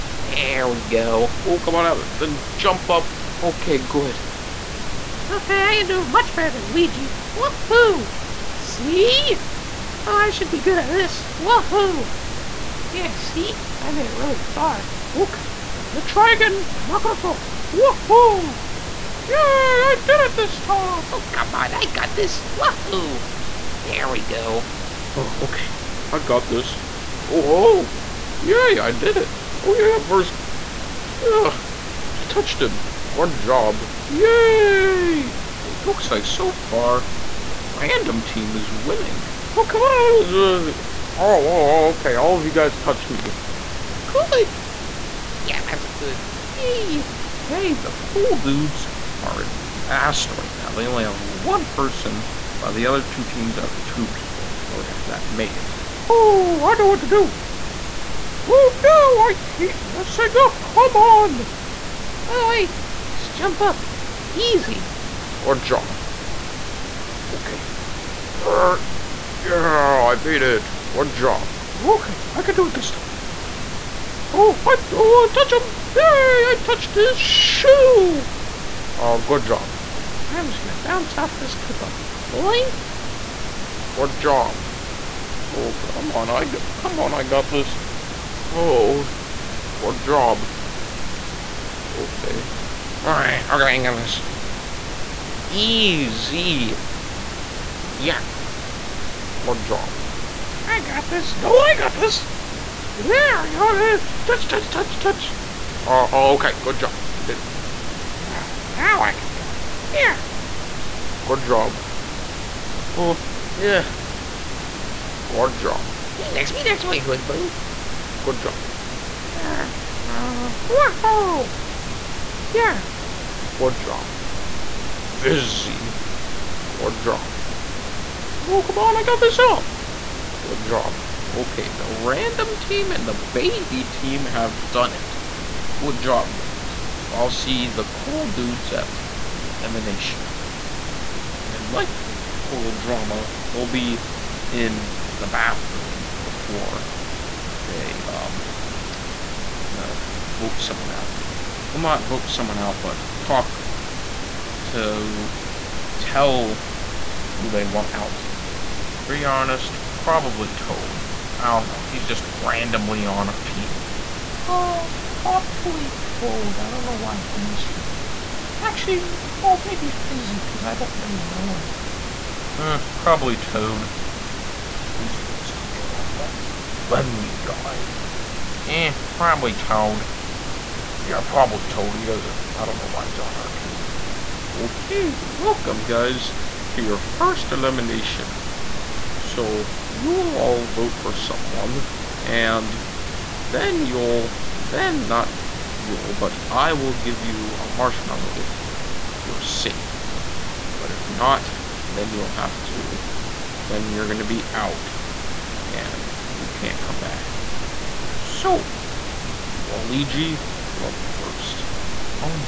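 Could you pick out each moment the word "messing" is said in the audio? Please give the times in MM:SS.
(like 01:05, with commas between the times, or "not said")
00:59.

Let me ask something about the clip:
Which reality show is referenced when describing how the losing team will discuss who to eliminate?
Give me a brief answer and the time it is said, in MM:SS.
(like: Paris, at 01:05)
Total Drama, at 02:22.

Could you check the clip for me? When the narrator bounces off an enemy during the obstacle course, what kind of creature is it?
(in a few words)
Koopa.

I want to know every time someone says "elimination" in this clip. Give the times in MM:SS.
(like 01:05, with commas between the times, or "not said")
02:19, 03:07.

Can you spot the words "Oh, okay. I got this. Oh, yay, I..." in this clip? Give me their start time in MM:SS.
00:25.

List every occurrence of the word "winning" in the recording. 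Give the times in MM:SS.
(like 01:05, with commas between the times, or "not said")
00:38.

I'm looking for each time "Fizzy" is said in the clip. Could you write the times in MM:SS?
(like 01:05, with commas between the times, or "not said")
02:04, 02:49, 02:54.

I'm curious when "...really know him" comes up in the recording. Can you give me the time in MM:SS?
02:50.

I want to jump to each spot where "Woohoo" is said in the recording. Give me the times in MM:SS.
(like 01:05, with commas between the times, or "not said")
00:07, 00:11, 00:17, 00:22.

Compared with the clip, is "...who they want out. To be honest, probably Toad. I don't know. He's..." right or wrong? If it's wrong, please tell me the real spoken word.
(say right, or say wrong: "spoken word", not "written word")
right.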